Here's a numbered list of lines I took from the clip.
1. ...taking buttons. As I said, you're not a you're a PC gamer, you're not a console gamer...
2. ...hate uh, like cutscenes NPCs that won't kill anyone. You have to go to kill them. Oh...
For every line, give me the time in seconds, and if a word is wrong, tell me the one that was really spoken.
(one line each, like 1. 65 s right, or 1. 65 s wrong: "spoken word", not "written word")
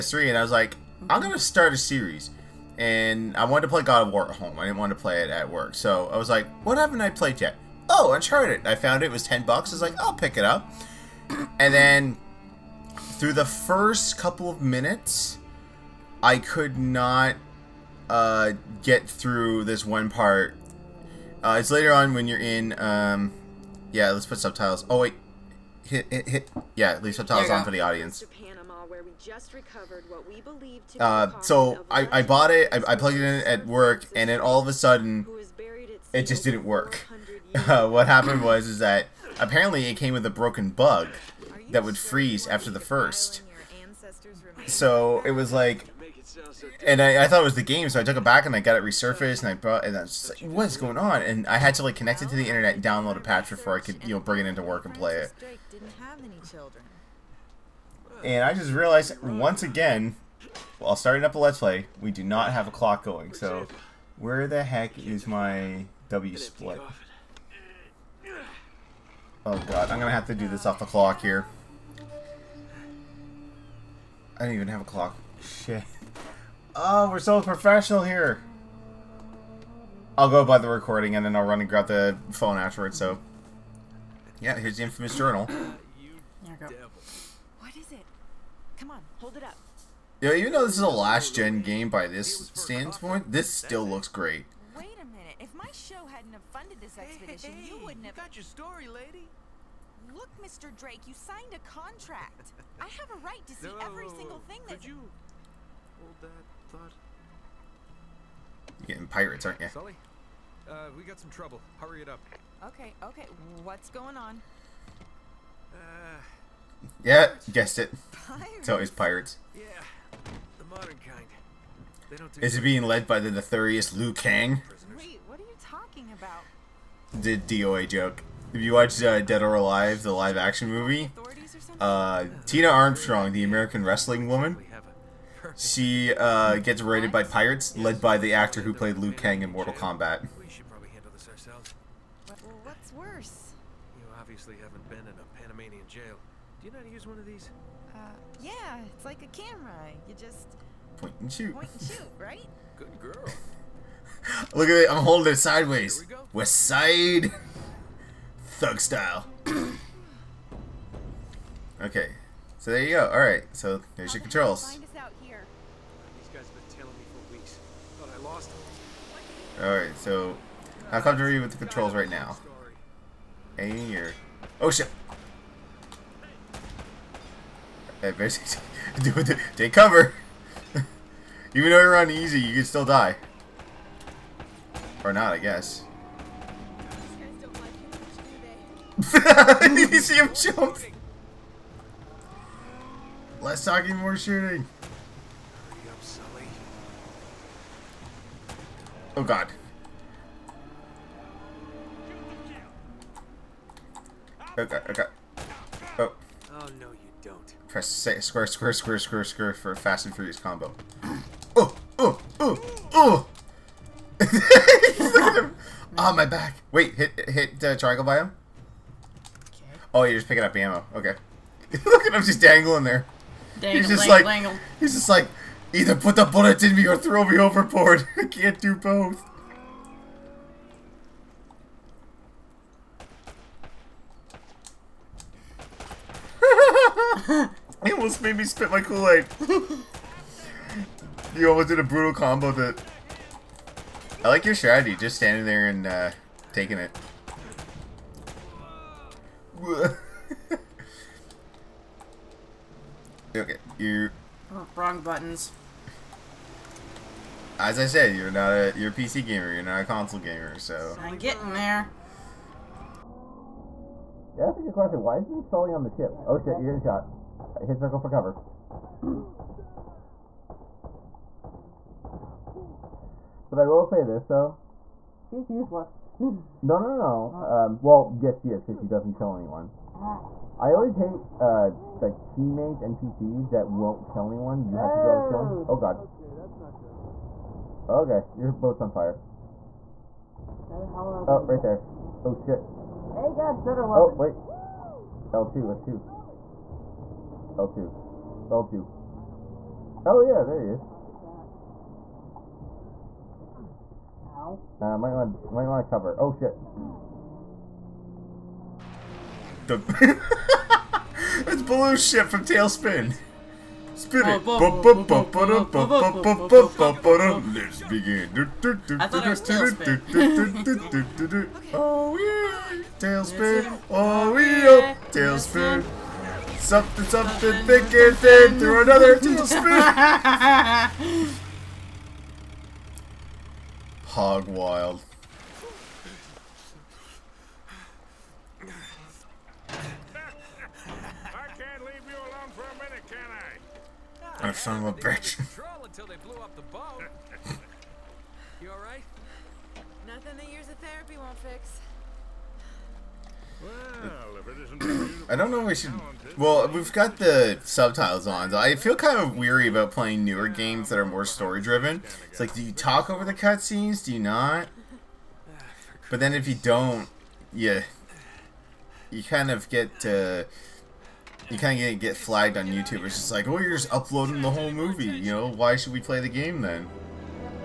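1. 254 s wrong: "wrong", not "taking"
2. 280 s wrong: "teammates", not "cutscenes".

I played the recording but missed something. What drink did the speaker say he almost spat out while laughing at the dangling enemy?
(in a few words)
Kool-Aid.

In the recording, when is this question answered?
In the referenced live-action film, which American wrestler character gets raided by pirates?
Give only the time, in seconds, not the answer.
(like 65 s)
132 s.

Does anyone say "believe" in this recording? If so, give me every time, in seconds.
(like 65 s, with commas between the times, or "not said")
30 s.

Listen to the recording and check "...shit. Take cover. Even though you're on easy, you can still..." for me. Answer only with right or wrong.
right.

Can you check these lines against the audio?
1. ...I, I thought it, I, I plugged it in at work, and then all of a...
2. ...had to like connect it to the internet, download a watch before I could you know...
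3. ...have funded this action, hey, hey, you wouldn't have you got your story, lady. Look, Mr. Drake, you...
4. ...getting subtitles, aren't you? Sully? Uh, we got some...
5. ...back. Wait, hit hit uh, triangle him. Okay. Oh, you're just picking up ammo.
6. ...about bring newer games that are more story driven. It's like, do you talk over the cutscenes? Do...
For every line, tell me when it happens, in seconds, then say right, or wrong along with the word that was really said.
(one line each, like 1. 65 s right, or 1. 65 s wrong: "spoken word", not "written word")
1. 31 s wrong: "bought", not "thought"
2. 51 s wrong: "patch", not "watch"
3. 96 s wrong: "expedition", not "action"
4. 108 s wrong: "pirates", not "subtitles"
5. 216 s right
6. 359 s wrong: "playing", not "bring".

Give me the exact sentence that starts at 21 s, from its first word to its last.
Uh, it's later on when you're in, um, yeah, let's put subtitles.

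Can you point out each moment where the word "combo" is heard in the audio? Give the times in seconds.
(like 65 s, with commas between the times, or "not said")
210 s, 242 s.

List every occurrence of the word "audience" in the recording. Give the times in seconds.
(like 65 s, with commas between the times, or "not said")
27 s.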